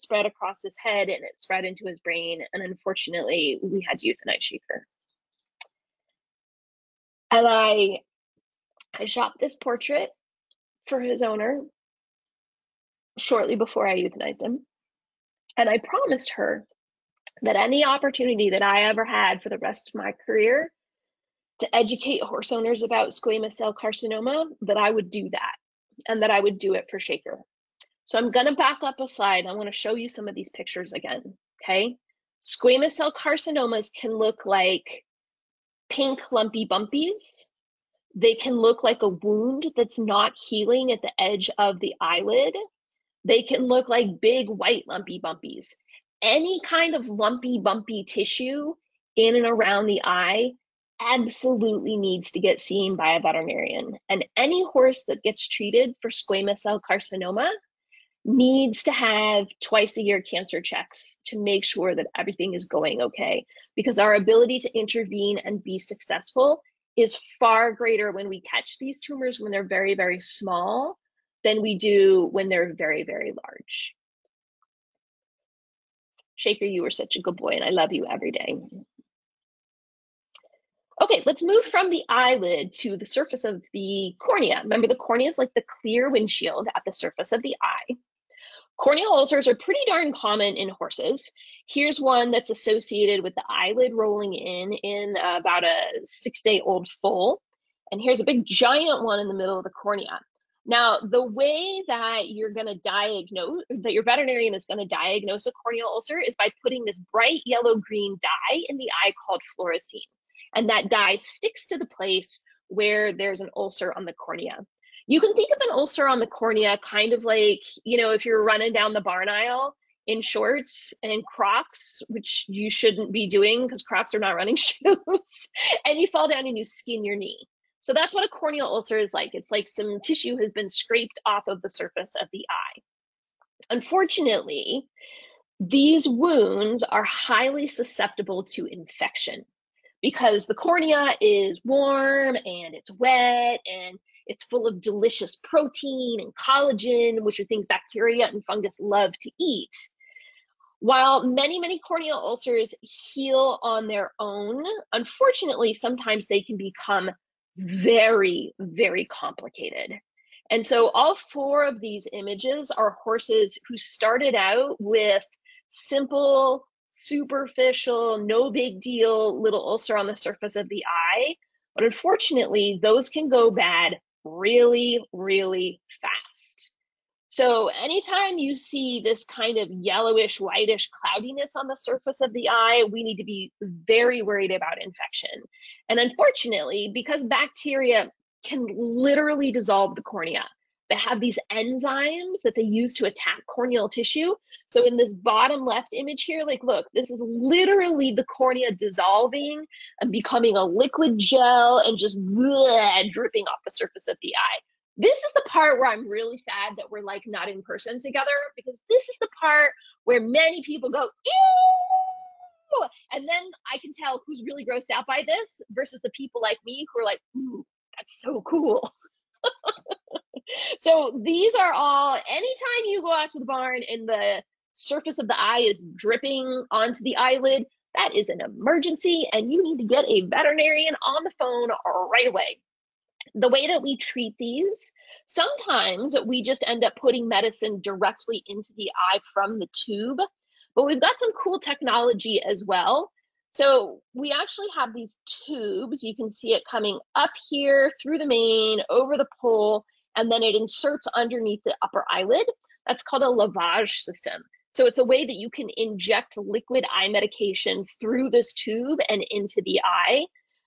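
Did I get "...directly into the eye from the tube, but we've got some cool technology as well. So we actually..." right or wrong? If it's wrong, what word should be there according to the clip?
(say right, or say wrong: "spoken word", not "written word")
right.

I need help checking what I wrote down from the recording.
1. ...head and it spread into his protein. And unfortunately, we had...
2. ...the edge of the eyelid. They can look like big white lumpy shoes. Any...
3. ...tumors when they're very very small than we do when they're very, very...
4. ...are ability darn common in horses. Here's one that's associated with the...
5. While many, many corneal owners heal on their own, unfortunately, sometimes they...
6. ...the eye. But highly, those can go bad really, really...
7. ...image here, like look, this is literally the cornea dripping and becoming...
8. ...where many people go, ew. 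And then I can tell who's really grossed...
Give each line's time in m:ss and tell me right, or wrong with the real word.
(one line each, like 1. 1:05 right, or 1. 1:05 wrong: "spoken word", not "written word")
1. 0:00 wrong: "brain", not "protein"
2. 0:41 wrong: "bumpies", not "shoes"
3. 1:09 right
4. 1:29 wrong: "pretty", not "ability"
5. 2:30 wrong: "ulcers", not "owners"
6. 2:50 wrong: "unfortunately", not "highly"
7. 3:15 wrong: "dissolving", not "dripping"
8. 3:30 right.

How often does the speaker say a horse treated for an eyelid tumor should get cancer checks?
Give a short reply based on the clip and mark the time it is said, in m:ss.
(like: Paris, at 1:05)
Twice a year, at 0:59.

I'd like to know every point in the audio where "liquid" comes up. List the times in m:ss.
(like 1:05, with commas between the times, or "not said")
3:20, 4:16.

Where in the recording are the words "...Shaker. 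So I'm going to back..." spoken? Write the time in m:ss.
0:26.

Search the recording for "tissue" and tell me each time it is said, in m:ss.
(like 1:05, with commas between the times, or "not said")
0:48, 2:09, 3:13.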